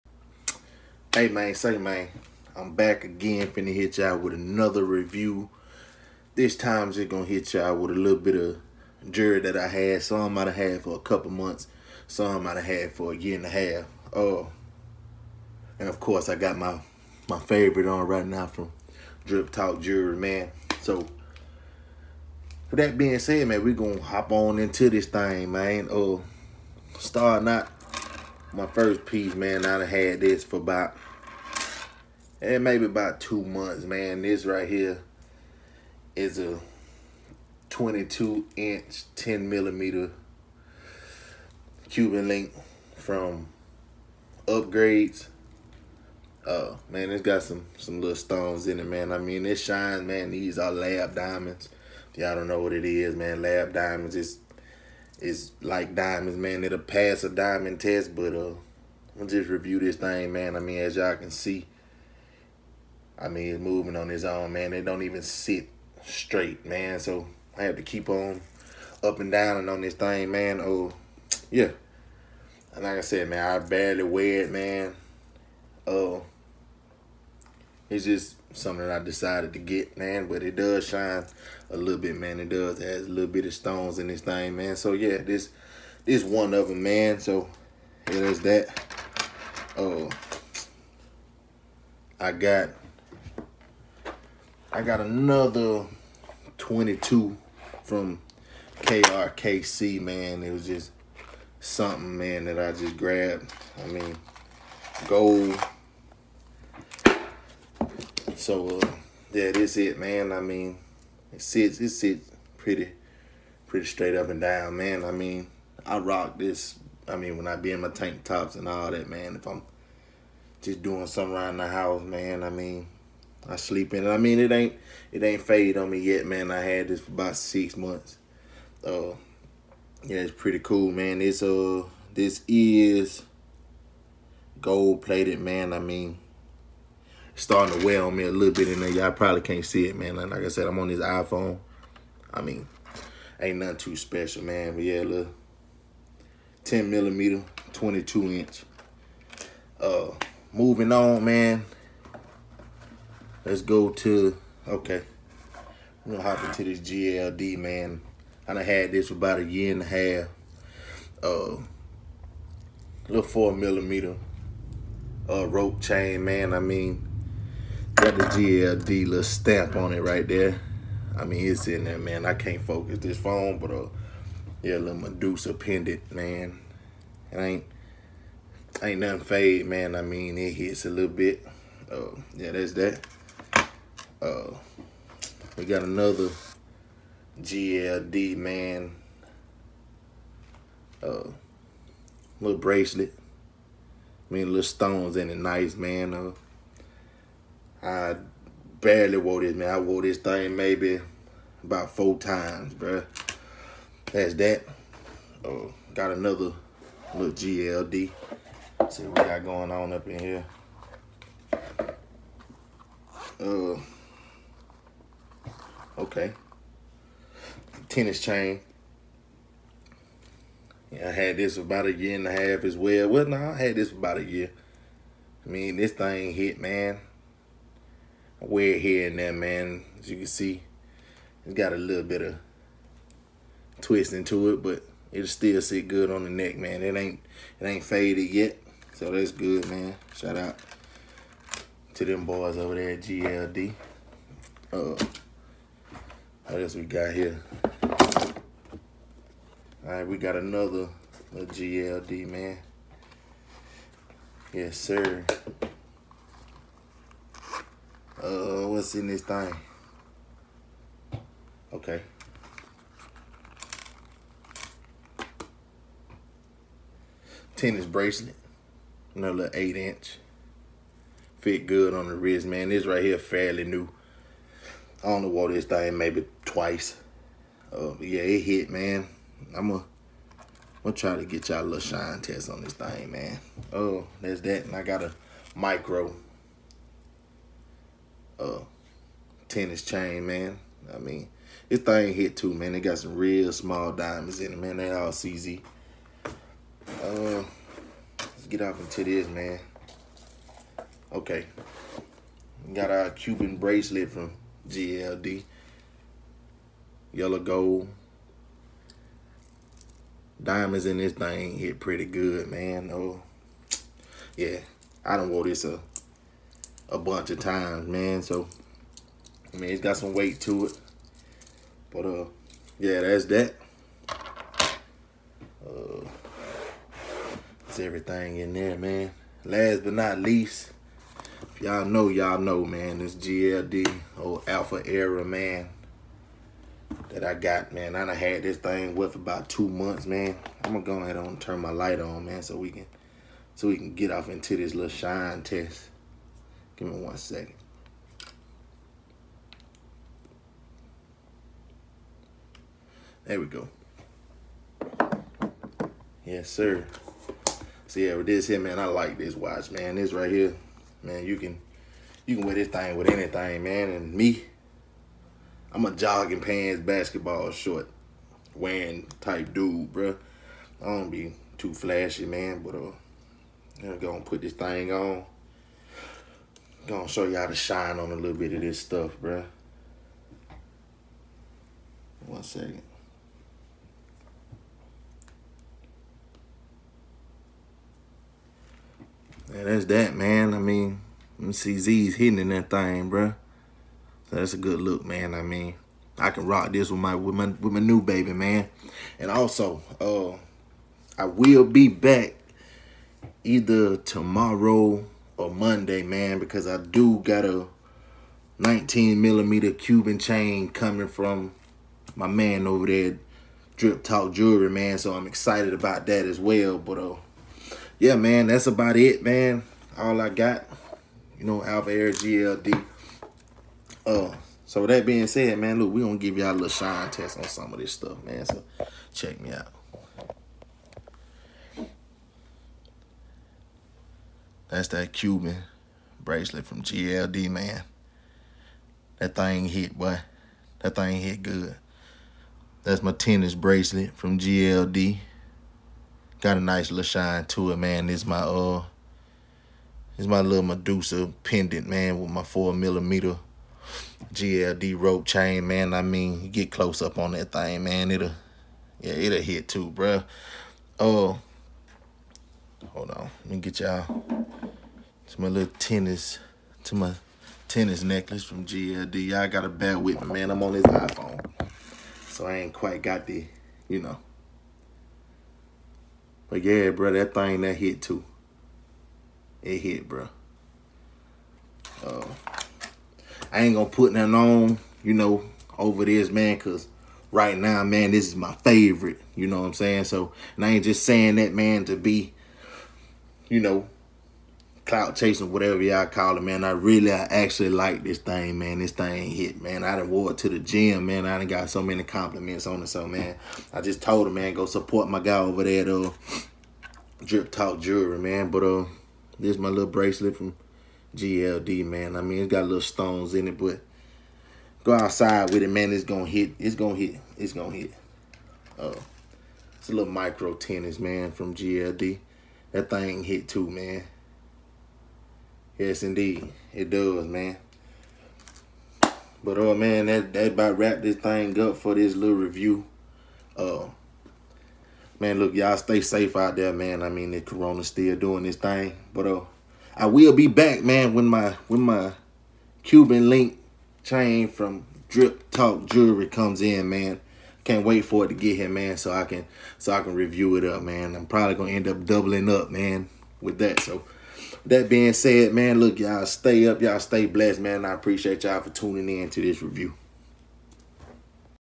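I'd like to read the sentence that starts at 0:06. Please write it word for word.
This time just gonna hit y'all with a little bit of jury that I had.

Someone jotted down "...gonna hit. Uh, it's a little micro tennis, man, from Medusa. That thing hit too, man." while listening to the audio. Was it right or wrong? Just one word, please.
wrong.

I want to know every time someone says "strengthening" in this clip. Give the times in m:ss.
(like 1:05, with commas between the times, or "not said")
not said.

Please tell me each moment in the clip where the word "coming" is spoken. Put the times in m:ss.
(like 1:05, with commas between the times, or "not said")
6:50.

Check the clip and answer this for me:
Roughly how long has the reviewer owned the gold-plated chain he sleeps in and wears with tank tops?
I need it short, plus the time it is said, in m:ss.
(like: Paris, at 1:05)
6 months, at 2:07.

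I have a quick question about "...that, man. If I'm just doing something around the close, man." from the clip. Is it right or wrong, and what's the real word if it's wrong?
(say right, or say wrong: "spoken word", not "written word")
wrong: "house", not "close".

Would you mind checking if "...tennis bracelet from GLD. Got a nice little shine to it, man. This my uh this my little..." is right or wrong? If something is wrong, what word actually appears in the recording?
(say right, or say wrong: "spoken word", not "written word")
right.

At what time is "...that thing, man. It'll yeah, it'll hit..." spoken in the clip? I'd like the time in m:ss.
7:37.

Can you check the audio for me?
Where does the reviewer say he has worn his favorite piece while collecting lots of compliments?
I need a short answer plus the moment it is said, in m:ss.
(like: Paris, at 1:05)
the gym, at 8:20.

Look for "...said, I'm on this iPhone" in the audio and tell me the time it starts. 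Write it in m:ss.
2:20.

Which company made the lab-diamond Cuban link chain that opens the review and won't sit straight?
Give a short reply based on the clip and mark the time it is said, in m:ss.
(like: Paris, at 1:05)
Upgradez, at 0:44.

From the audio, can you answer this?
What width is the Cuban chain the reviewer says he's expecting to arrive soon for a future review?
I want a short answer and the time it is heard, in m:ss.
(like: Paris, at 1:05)
19 millimeter, at 6:48.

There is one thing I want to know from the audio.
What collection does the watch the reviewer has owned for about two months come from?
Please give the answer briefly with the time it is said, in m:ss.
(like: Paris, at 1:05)
Alpha Era, at 5:34.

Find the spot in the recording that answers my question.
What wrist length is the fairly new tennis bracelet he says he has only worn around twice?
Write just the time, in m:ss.
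4:29.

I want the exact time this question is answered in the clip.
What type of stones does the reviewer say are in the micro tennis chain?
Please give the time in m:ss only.
4:55.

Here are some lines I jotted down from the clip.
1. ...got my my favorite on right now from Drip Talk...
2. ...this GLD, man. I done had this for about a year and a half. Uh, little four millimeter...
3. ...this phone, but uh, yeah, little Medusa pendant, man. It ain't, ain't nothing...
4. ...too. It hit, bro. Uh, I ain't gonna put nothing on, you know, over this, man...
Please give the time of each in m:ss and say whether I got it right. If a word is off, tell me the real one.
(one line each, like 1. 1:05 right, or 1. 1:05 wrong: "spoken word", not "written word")
1. 0:16 right
2. 2:36 right
3. 2:52 right
4. 7:58 right.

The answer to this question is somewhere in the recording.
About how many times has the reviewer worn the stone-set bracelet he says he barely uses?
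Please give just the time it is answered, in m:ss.
3:21.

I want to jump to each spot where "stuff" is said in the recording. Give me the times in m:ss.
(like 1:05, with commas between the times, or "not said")
6:18, 7:07.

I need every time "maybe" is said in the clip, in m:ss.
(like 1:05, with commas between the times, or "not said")
0:32, 3:20, 4:35.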